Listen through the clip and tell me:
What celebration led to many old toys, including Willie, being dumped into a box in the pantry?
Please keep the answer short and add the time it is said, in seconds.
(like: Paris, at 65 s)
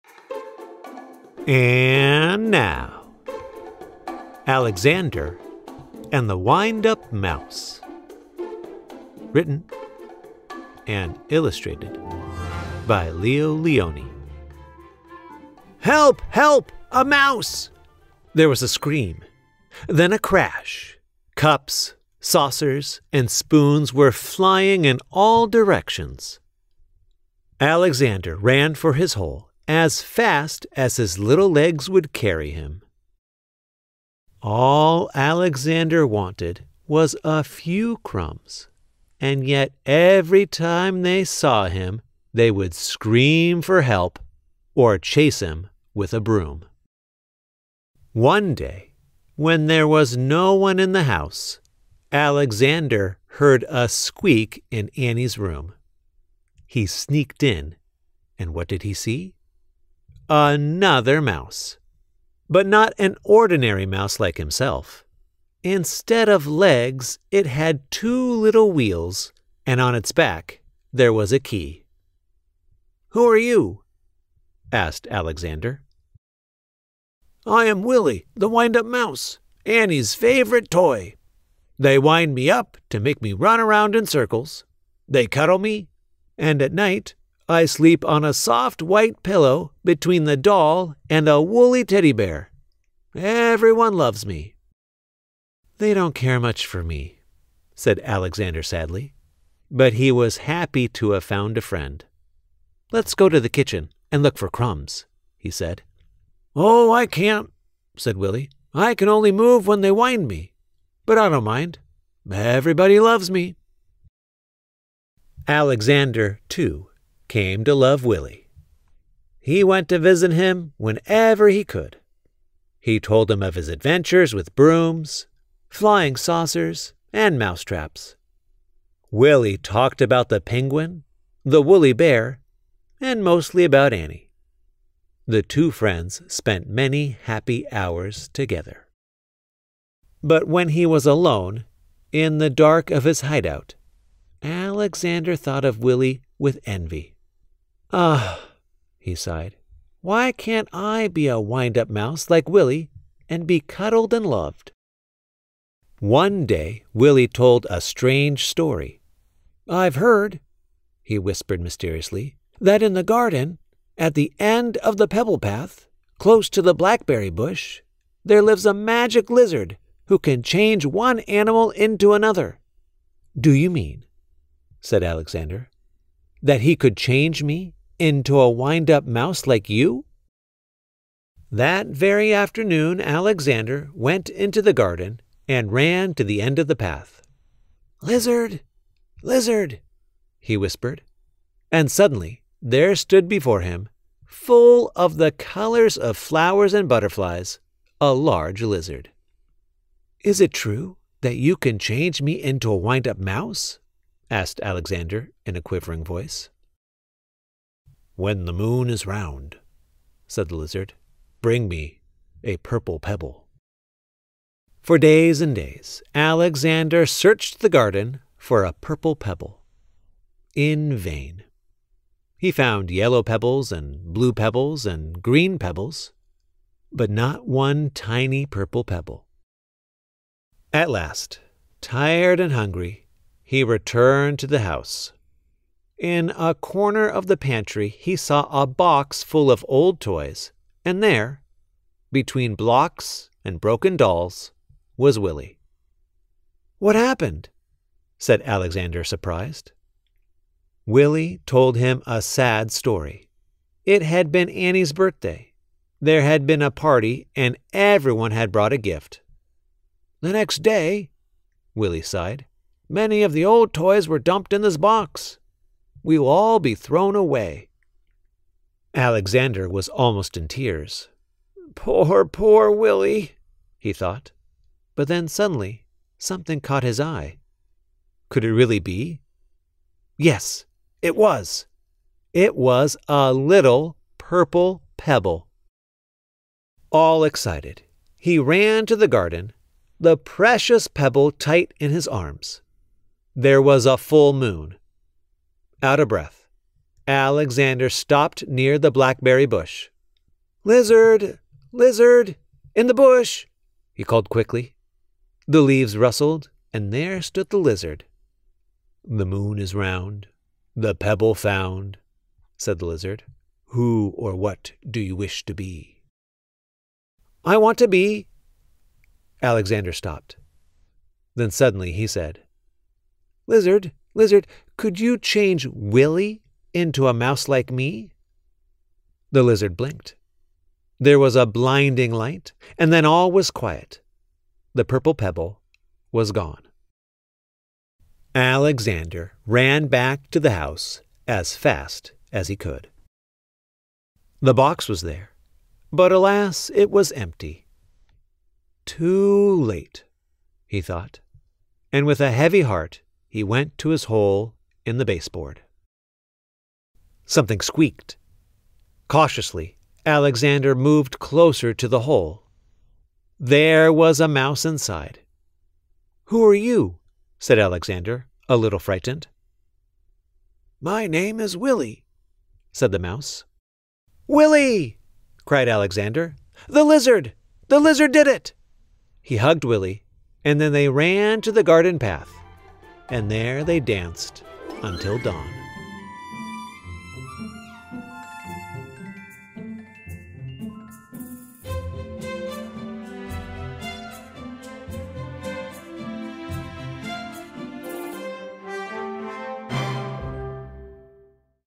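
Annie's birthday, at 254 s.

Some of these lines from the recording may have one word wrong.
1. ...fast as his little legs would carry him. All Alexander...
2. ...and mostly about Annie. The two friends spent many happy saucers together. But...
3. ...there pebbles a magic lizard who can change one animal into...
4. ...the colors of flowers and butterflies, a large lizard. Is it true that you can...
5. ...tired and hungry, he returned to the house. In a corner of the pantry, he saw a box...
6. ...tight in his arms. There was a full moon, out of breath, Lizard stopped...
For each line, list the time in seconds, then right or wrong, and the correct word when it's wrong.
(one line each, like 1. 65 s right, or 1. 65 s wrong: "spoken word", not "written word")
1. 30 s right
2. 132 s wrong: "hours", not "saucers"
3. 168 s wrong: "lives", not "pebbles"
4. 195 s right
5. 231 s right
6. 291 s wrong: "Alexander", not "Lizard".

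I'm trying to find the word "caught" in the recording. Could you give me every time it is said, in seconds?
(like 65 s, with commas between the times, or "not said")
276 s.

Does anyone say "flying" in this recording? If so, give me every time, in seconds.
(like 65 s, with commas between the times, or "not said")
24 s, 125 s.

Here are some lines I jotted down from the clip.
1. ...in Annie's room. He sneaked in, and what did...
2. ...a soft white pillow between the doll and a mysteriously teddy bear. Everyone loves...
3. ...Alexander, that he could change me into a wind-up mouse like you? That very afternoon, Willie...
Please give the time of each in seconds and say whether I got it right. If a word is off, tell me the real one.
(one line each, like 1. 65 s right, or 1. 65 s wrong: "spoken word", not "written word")
1. 54 s right
2. 88 s wrong: "woolly", not "mysteriously"
3. 175 s wrong: "Alexander", not "Willie".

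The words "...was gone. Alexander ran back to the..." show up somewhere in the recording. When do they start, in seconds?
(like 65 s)
336 s.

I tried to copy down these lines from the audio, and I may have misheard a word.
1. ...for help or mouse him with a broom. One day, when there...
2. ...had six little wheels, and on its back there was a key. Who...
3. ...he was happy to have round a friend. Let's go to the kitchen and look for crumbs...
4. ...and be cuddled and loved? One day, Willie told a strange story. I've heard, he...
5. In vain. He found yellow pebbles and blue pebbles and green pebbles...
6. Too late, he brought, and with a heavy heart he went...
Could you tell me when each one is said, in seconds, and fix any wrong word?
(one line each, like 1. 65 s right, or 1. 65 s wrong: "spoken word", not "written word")
1. 43 s wrong: "chase", not "mouse"
2. 67 s wrong: "two", not "six"
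3. 99 s wrong: "found", not "round"
4. 153 s right
5. 220 s right
6. 348 s wrong: "thought", not "brought".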